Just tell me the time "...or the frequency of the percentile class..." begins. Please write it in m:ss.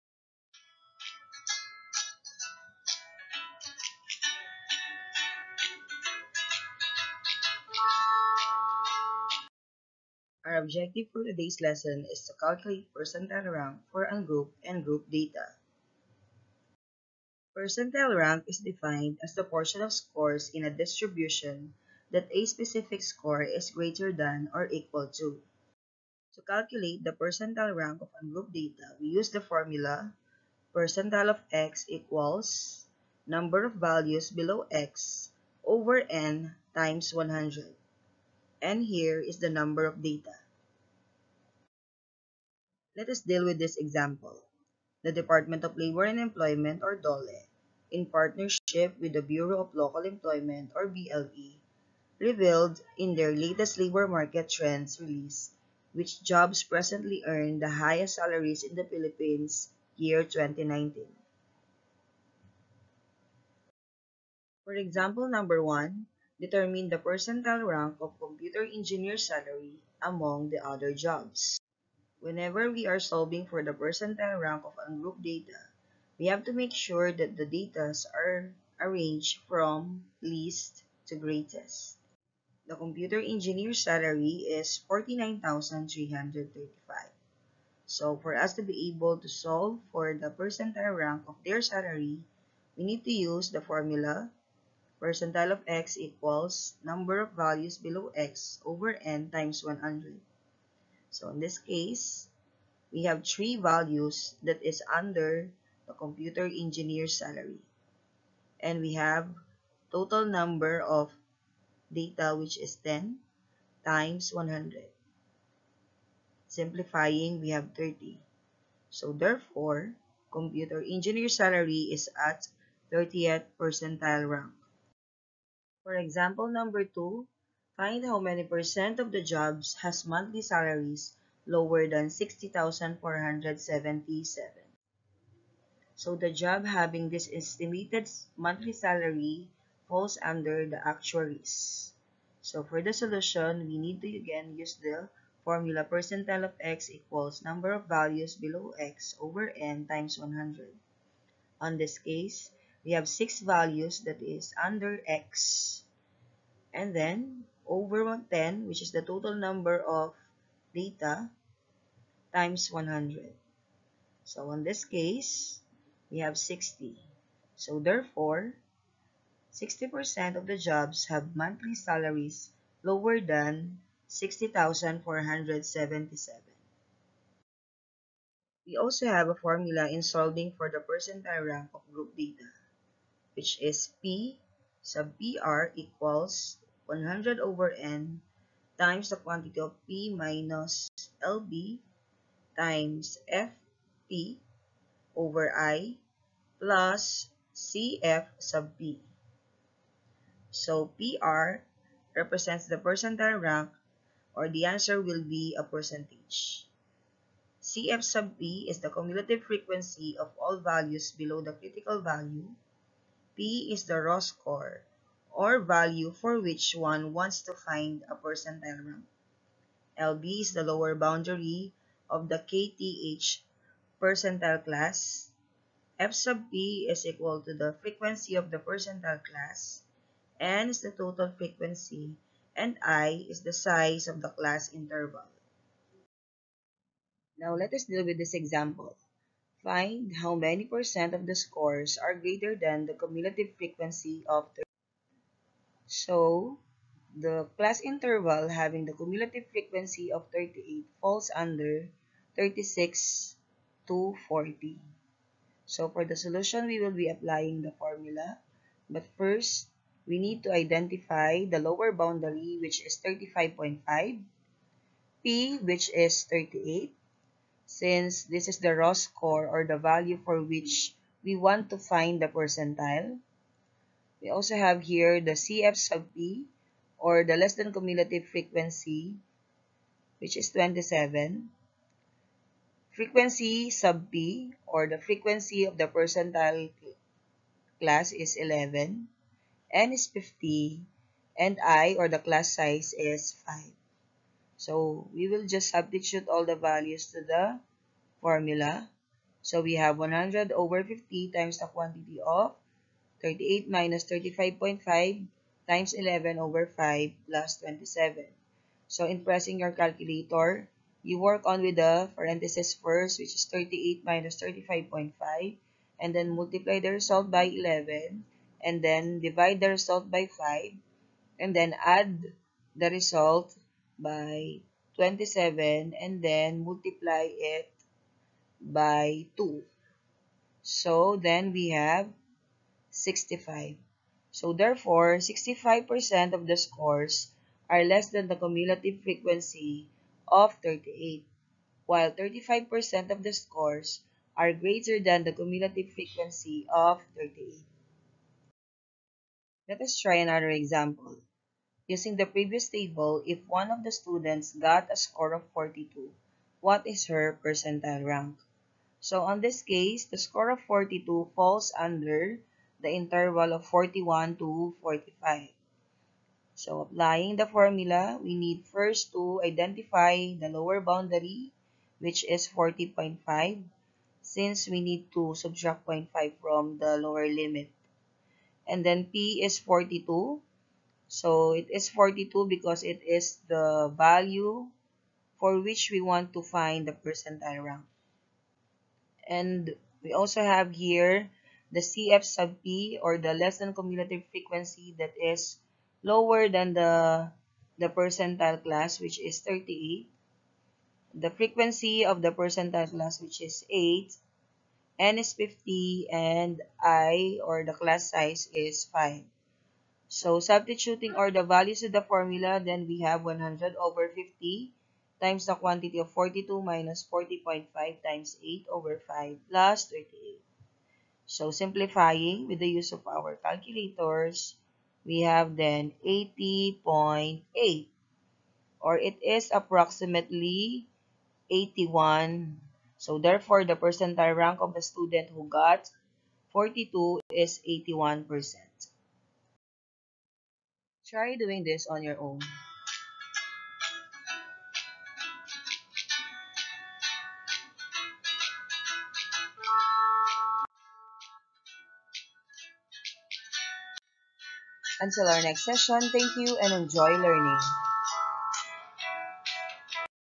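4:44.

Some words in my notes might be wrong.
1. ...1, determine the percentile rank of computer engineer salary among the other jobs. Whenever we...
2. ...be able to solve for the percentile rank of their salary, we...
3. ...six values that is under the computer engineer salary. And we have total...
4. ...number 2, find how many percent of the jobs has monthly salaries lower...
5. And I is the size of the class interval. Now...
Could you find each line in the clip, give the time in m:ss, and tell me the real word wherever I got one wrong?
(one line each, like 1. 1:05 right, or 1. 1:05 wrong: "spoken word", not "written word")
1. 1:05 right
2. 1:28 right
3. 1:43 wrong: "three", not "six"
4. 2:06 right
5. 3:52 right.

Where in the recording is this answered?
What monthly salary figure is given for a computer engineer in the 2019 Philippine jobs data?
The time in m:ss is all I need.
1:24.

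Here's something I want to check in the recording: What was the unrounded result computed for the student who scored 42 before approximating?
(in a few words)
80.8.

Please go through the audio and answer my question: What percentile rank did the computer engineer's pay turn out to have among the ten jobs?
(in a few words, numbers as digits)
30th.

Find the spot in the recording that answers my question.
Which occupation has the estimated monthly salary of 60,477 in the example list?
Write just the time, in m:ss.
2:20.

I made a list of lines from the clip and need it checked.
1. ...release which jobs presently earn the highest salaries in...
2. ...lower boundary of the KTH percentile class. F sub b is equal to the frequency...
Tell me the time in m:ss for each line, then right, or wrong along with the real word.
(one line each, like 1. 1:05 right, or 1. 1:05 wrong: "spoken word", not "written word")
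1. 0:54 right
2. 3:40 right.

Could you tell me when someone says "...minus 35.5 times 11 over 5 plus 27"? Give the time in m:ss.
5:03.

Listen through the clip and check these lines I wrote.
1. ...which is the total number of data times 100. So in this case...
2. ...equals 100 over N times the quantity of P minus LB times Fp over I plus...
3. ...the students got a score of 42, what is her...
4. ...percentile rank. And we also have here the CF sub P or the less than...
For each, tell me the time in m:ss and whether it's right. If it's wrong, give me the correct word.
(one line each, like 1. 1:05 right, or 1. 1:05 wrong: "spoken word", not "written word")
1. 2:38 right
2. 3:05 right
3. 5:53 right
4. 6:26 right.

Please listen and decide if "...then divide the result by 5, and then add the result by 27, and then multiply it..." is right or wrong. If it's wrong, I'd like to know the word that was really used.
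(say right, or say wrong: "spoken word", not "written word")
right.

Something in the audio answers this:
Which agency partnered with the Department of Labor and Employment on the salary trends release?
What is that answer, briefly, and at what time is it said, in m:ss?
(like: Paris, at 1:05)
Bureau of Local Employment, at 0:49.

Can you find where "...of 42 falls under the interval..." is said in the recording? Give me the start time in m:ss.
6:00.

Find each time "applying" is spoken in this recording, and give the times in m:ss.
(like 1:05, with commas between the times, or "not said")
4:17, 6:06.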